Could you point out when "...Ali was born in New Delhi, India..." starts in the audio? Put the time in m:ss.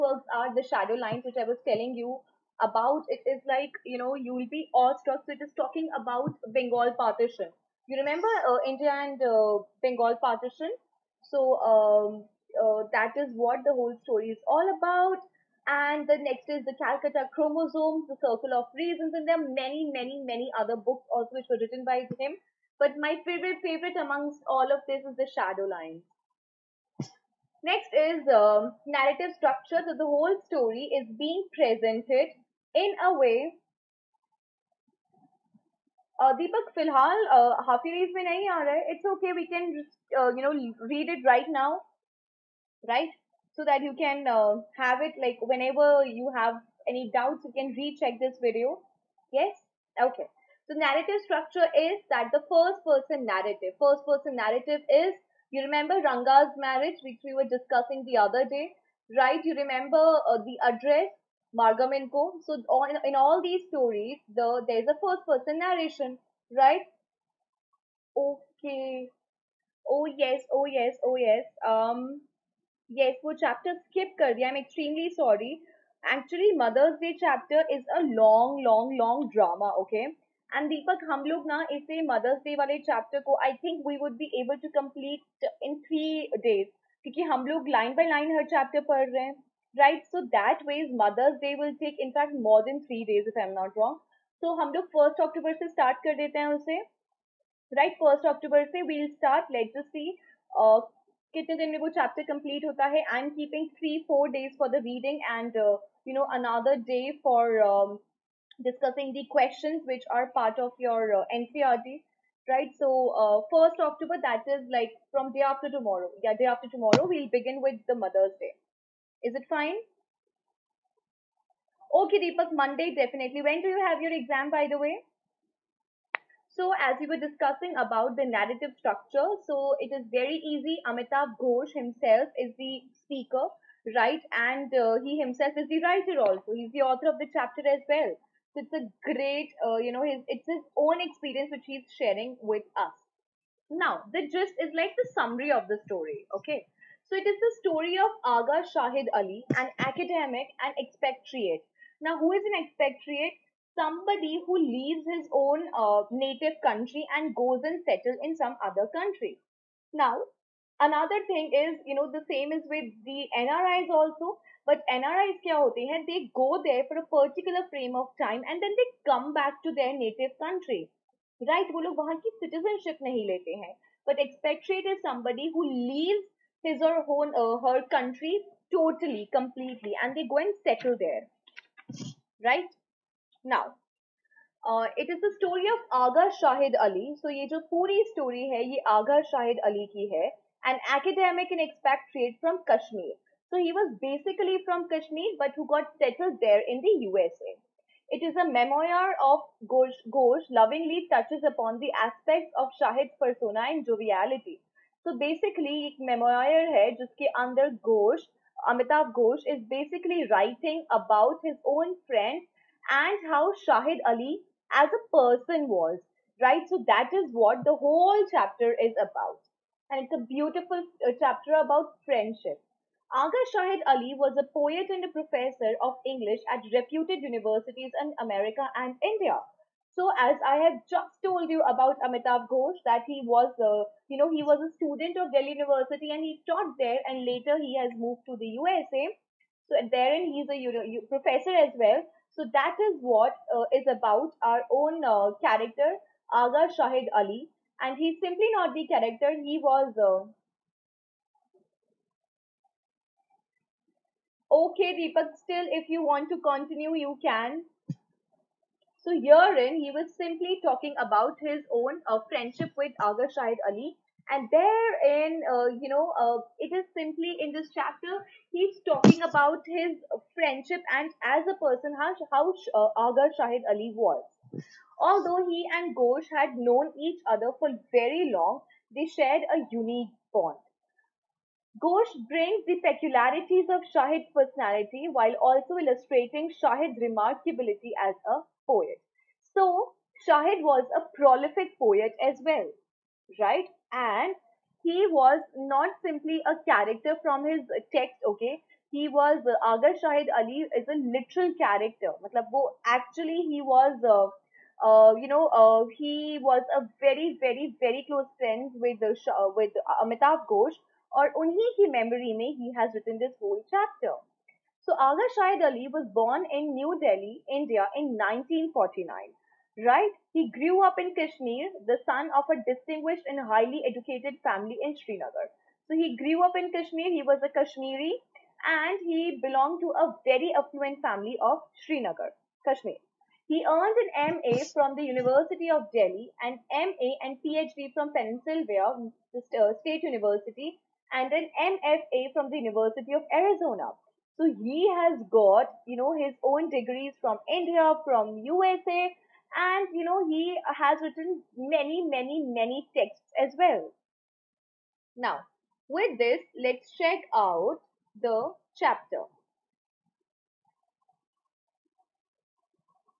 5:15.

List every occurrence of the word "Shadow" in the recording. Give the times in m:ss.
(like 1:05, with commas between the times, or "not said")
0:00, 0:25.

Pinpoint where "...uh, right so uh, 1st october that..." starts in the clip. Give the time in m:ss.
1:51.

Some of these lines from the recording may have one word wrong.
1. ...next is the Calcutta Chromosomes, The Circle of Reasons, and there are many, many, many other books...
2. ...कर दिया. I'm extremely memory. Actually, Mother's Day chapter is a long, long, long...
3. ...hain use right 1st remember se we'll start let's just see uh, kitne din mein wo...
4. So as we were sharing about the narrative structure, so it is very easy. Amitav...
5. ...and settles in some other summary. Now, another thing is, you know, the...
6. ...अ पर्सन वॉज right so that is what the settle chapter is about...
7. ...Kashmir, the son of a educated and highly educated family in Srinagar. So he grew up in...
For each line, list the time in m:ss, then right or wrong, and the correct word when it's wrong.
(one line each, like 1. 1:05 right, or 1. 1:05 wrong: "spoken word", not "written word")
1. 0:16 right
2. 1:14 wrong: "sorry", not "memory"
3. 1:36 wrong: "october", not "remember"
4. 2:06 wrong: "discussing", not "sharing"
5. 2:37 wrong: "country", not "summary"
6. 3:34 wrong: "whole", not "settle"
7. 5:21 wrong: "distinguished", not "educated".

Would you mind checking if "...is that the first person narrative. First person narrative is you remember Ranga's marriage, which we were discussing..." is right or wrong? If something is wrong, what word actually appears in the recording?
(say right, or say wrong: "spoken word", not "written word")
right.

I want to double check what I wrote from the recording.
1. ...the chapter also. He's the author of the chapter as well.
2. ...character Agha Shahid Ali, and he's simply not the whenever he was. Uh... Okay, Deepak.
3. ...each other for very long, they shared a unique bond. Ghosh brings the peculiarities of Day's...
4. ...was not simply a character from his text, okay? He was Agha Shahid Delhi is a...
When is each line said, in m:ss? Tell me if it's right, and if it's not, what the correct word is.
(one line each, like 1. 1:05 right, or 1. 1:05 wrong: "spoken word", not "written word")
1. 2:15 wrong: "writer", not "chapter"
2. 4:05 wrong: "character", not "whenever"
3. 4:36 wrong: "Shahid", not "Day"
4. 4:55 wrong: "Ali", not "Delhi".